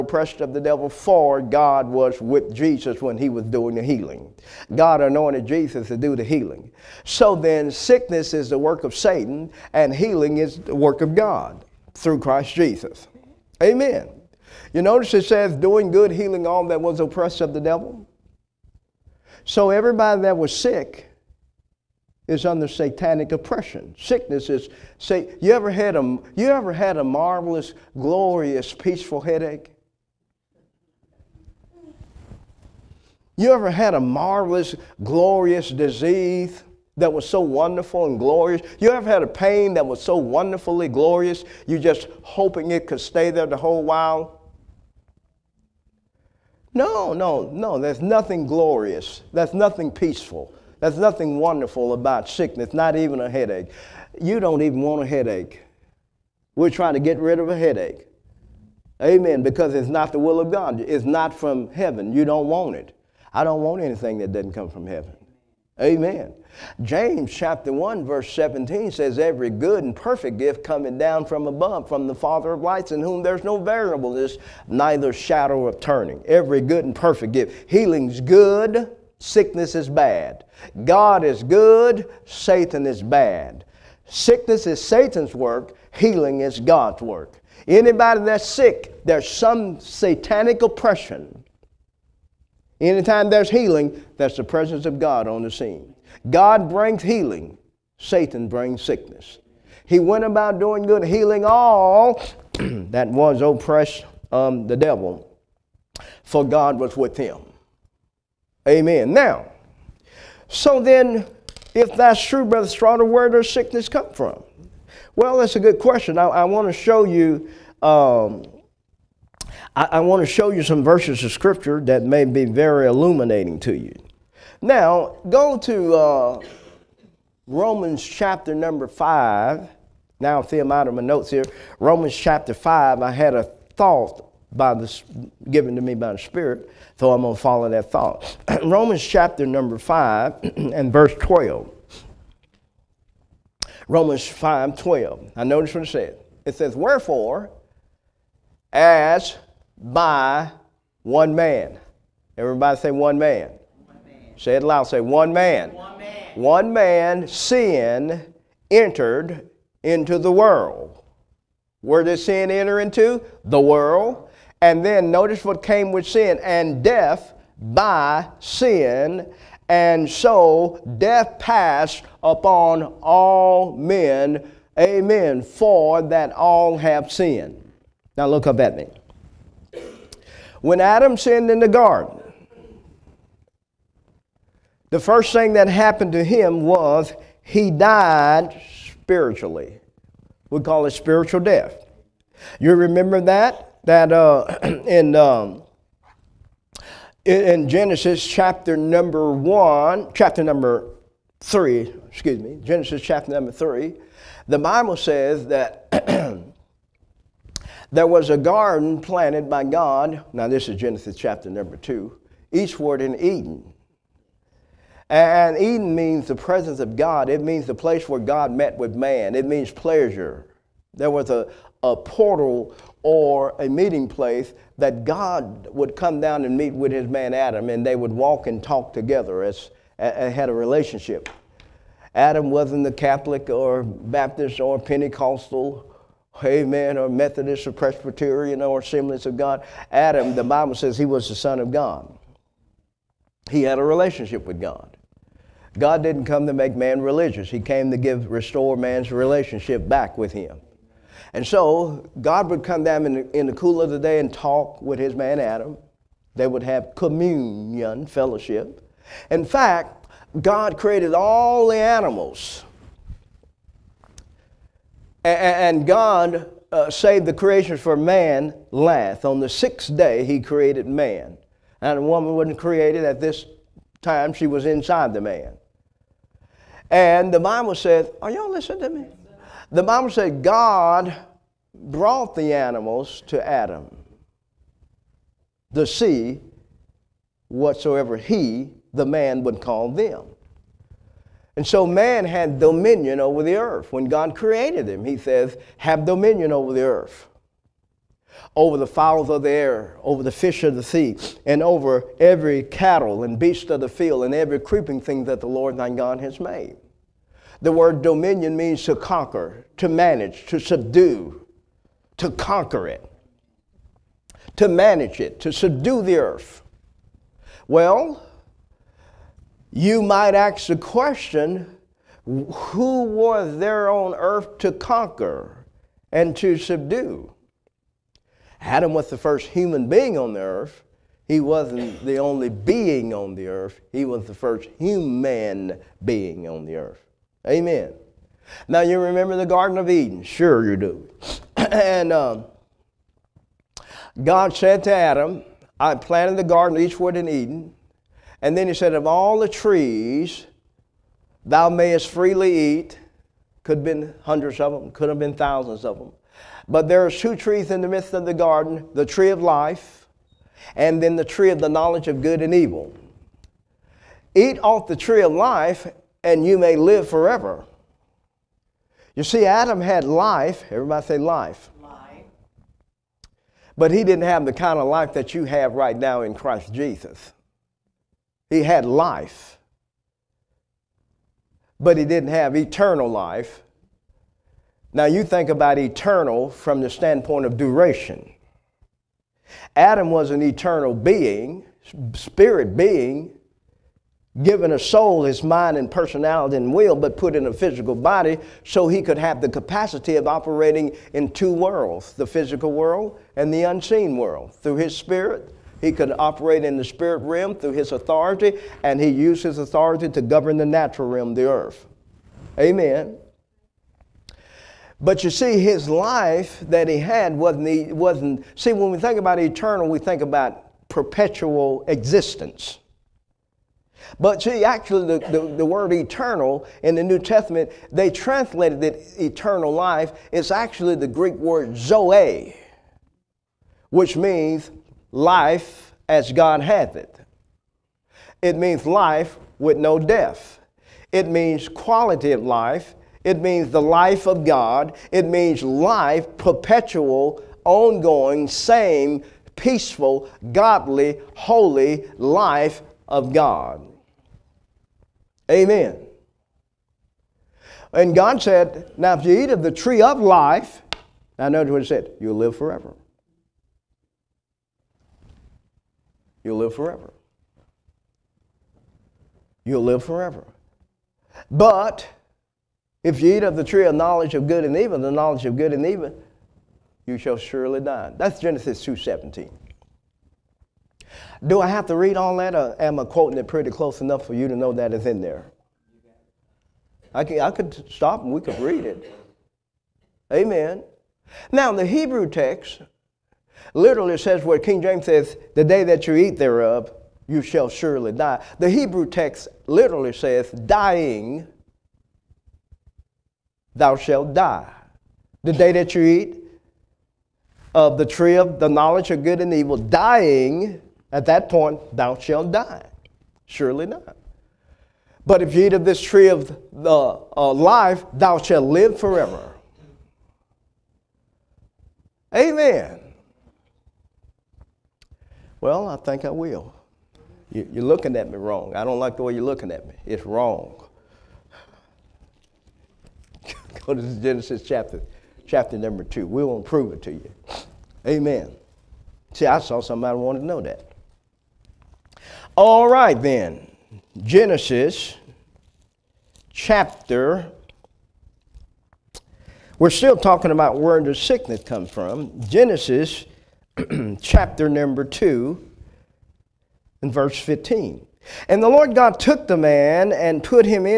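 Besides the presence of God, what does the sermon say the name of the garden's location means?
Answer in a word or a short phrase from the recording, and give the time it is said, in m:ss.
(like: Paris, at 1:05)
Pleasure, at 3:39.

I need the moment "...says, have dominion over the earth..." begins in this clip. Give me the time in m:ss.
4:55.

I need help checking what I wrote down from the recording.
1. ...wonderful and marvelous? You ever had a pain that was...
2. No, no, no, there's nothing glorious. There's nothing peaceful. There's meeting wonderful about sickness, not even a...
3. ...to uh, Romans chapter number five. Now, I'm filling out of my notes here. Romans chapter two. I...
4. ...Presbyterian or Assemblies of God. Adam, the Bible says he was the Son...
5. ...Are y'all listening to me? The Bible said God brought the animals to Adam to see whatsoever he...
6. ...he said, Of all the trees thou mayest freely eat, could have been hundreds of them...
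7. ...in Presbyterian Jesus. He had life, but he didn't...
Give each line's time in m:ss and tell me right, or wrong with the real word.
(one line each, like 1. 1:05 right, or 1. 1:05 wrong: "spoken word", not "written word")
1. 0:37 wrong: "glorious", not "marvelous"
2. 0:46 wrong: "nothing", not "meeting"
3. 2:05 wrong: "five", not "two"
4. 3:57 right
5. 4:38 right
6. 5:48 right
7. 6:16 wrong: "Christ", not "Presbyterian".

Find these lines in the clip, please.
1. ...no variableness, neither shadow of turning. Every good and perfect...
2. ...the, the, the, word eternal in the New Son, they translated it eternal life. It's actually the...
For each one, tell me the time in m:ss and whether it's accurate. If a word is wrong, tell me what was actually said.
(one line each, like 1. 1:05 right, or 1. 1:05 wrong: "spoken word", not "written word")
1. 1:13 right
2. 7:05 wrong: "Testament", not "Son".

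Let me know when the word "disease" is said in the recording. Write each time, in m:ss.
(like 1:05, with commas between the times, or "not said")
0:35.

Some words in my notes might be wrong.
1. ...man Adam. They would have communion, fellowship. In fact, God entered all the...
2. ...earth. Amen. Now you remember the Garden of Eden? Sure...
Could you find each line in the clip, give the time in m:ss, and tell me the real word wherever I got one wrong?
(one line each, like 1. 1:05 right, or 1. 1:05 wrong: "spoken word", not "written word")
1. 4:15 wrong: "created", not "entered"
2. 5:36 right.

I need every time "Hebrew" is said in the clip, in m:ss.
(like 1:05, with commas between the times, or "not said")
8:11, 8:18.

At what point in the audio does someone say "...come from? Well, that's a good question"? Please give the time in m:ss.
1:53.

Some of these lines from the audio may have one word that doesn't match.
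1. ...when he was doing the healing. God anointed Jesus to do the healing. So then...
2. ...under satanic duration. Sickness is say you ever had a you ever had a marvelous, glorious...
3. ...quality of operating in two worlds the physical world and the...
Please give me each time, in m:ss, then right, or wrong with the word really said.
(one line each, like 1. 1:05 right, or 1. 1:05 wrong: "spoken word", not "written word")
1. 0:03 right
2. 0:22 wrong: "oppression", not "duration"
3. 6:39 wrong: "capacity", not "quality".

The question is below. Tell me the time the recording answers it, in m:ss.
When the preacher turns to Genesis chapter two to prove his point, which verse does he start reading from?
9:17.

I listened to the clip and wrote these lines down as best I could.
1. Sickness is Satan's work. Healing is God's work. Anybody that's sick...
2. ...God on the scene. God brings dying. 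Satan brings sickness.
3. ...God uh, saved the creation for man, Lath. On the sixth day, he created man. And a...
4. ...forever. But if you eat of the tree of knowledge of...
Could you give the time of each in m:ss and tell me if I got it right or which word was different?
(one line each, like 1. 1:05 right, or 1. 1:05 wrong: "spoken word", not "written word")
1. 1:24 right
2. 1:34 wrong: "healing", not "dying"
3. 4:25 right
4. 7:50 right.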